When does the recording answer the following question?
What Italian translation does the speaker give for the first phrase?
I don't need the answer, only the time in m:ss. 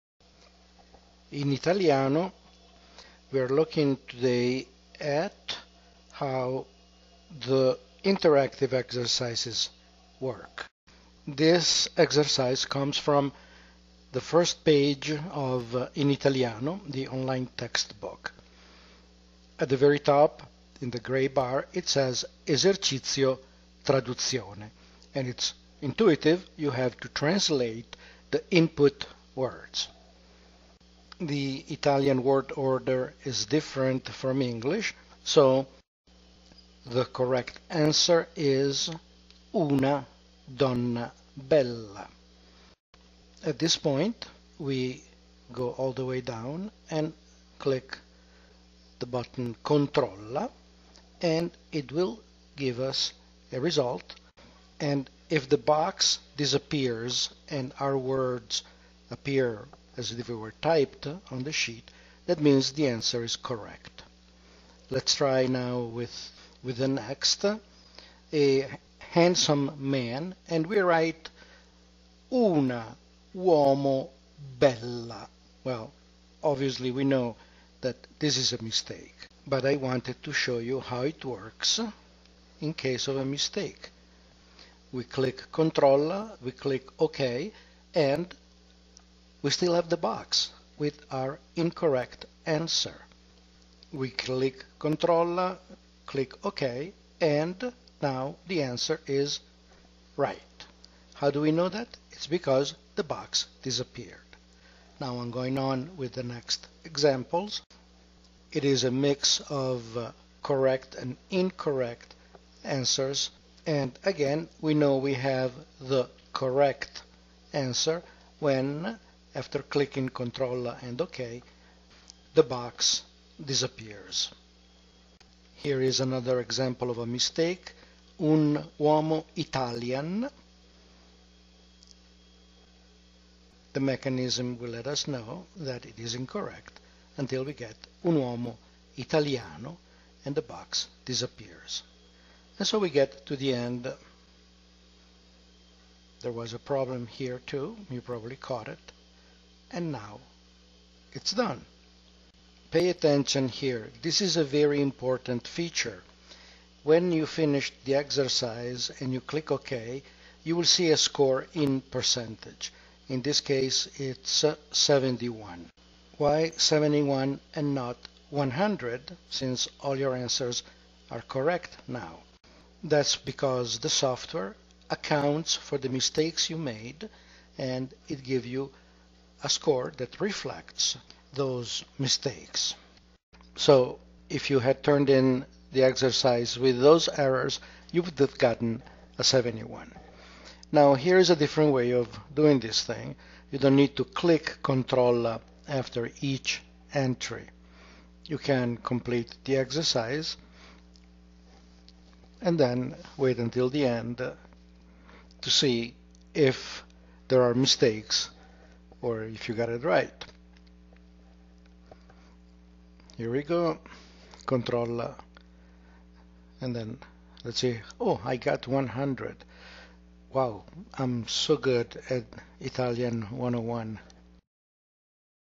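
0:39.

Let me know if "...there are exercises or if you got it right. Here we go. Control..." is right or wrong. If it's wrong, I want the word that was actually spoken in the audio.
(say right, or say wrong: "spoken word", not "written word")
wrong: "mistakes", not "exercises".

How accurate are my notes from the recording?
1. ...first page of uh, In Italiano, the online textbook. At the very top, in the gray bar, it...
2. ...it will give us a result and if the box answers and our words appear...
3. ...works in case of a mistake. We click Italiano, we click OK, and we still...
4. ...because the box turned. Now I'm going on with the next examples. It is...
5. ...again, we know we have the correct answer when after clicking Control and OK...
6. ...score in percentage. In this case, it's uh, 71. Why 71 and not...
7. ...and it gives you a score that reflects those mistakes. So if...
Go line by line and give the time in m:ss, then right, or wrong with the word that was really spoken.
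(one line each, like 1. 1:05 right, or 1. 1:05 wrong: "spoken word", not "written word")
1. 0:14 right
2. 0:51 wrong: "disappears", not "answers"
3. 1:21 wrong: "Control", not "Italiano"
4. 1:42 wrong: "disappeared", not "turned"
5. 1:54 right
6. 2:40 right
7. 2:57 right.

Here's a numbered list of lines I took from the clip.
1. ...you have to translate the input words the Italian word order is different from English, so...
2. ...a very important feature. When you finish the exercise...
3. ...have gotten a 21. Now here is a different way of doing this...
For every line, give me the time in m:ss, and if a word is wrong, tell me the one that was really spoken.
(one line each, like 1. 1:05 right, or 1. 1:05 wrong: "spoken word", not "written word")
1. 0:26 right
2. 2:34 right
3. 3:08 wrong: "71", not "21".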